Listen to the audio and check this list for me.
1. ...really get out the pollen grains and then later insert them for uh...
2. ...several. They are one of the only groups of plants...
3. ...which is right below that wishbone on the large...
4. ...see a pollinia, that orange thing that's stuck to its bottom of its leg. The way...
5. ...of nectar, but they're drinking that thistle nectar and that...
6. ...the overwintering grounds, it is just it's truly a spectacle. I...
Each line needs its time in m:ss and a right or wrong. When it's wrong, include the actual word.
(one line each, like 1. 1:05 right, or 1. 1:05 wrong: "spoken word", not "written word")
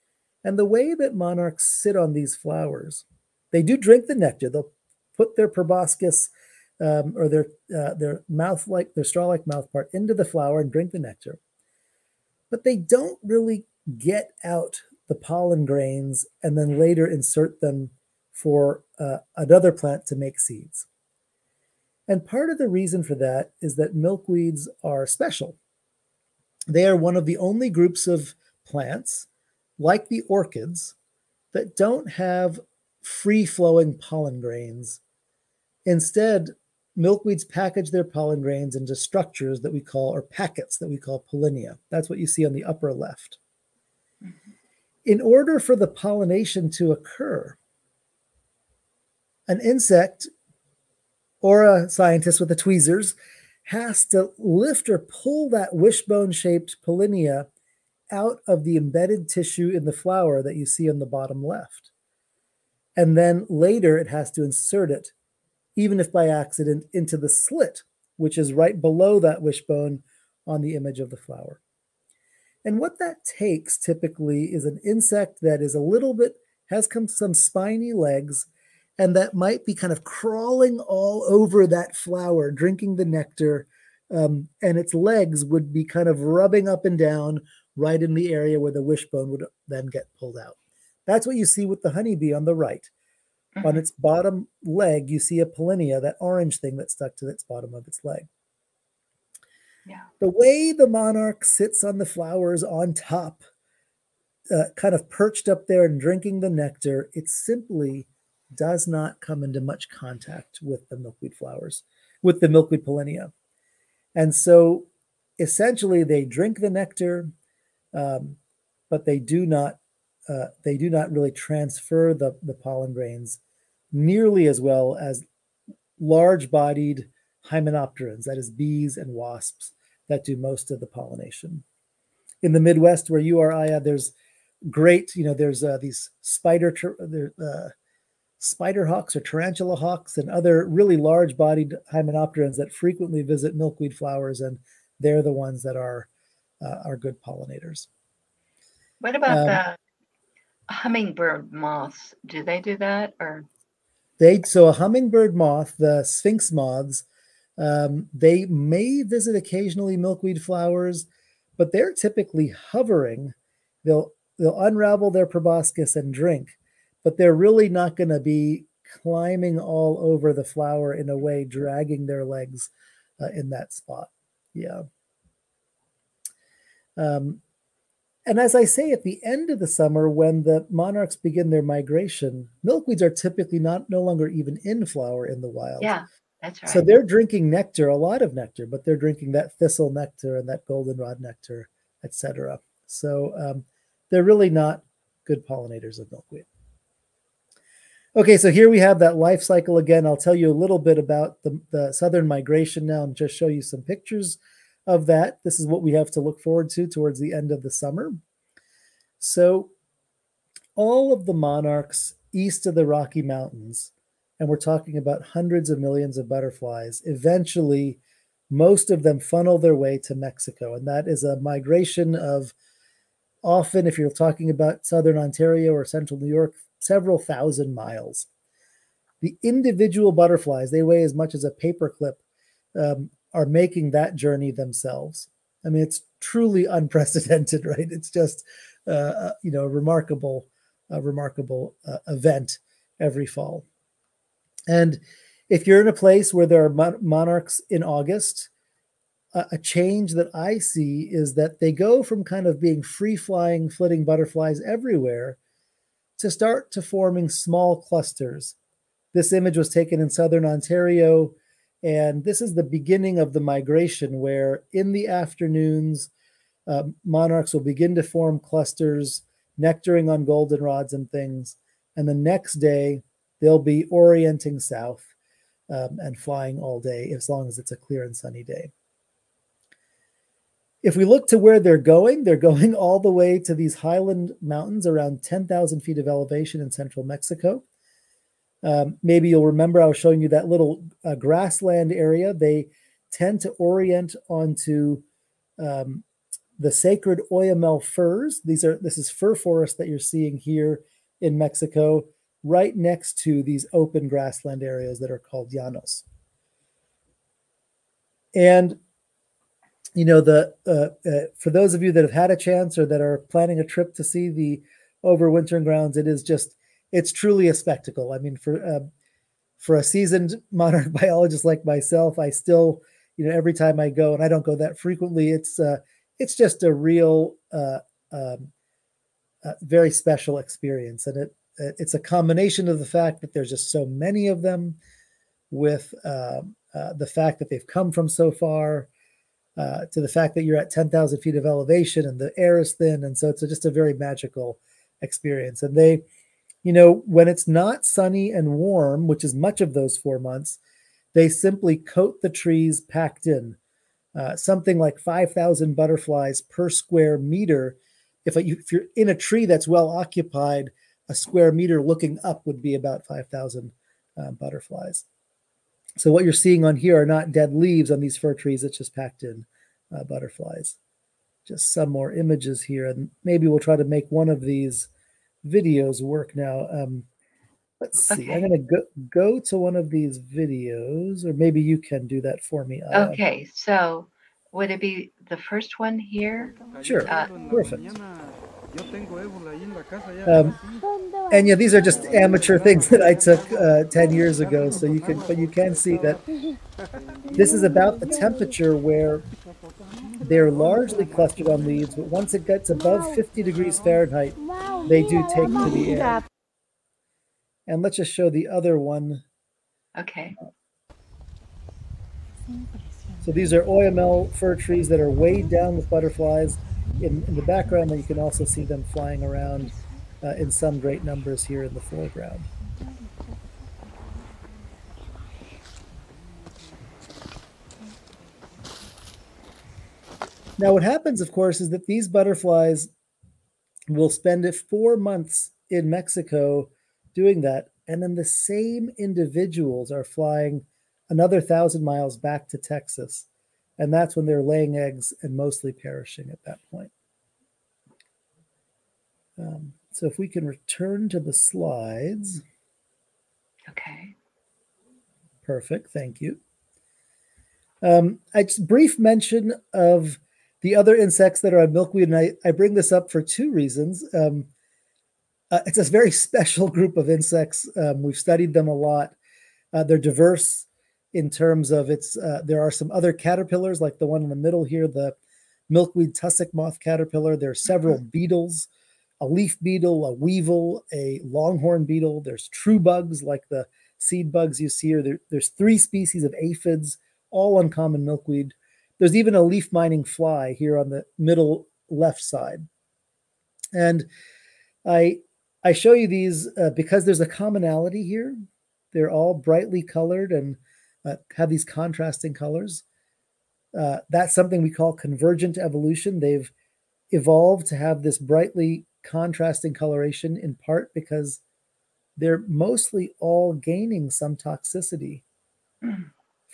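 1. 0:13 right
2. 0:25 wrong: "special", not "several"
3. 1:08 wrong: "image", not "large"
4. 1:35 right
5. 3:08 right
6. 5:14 right.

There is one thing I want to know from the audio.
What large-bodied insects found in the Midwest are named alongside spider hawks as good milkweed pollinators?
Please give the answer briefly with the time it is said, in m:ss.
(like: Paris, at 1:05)
tarantula hawks, at 2:19.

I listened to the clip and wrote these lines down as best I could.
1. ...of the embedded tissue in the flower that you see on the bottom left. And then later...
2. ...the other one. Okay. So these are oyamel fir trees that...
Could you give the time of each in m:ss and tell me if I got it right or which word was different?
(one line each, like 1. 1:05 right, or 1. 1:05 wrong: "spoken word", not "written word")
1. 0:58 right
2. 6:48 right.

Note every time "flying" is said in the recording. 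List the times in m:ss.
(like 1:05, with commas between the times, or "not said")
4:13, 4:36, 6:58, 7:20.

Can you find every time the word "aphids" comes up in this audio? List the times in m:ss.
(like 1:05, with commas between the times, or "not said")
8:06.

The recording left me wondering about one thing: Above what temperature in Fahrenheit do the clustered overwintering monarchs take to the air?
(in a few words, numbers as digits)
50 degrees.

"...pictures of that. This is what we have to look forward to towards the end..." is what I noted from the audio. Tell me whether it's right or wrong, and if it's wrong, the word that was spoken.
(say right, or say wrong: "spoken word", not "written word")
right.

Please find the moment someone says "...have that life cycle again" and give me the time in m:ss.
3:18.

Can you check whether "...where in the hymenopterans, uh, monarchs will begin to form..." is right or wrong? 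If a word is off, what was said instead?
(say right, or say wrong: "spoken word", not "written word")
wrong: "afternoons", not "hymenopterans".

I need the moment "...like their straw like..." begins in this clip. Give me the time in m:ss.
0:08.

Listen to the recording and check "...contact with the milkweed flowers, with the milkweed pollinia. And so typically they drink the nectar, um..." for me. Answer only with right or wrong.
wrong.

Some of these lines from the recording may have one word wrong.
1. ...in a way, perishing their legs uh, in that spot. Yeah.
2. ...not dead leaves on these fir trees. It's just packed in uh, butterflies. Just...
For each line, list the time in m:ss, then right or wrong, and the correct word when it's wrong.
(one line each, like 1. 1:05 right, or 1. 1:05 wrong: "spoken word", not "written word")
1. 2:50 wrong: "dragging", not "perishing"
2. 6:07 right.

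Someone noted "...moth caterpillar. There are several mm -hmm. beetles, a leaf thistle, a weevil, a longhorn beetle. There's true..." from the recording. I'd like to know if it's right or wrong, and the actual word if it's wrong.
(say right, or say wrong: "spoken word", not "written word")
wrong: "beetle", not "thistle".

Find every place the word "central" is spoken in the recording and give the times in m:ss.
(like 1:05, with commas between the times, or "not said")
3:45, 4:46.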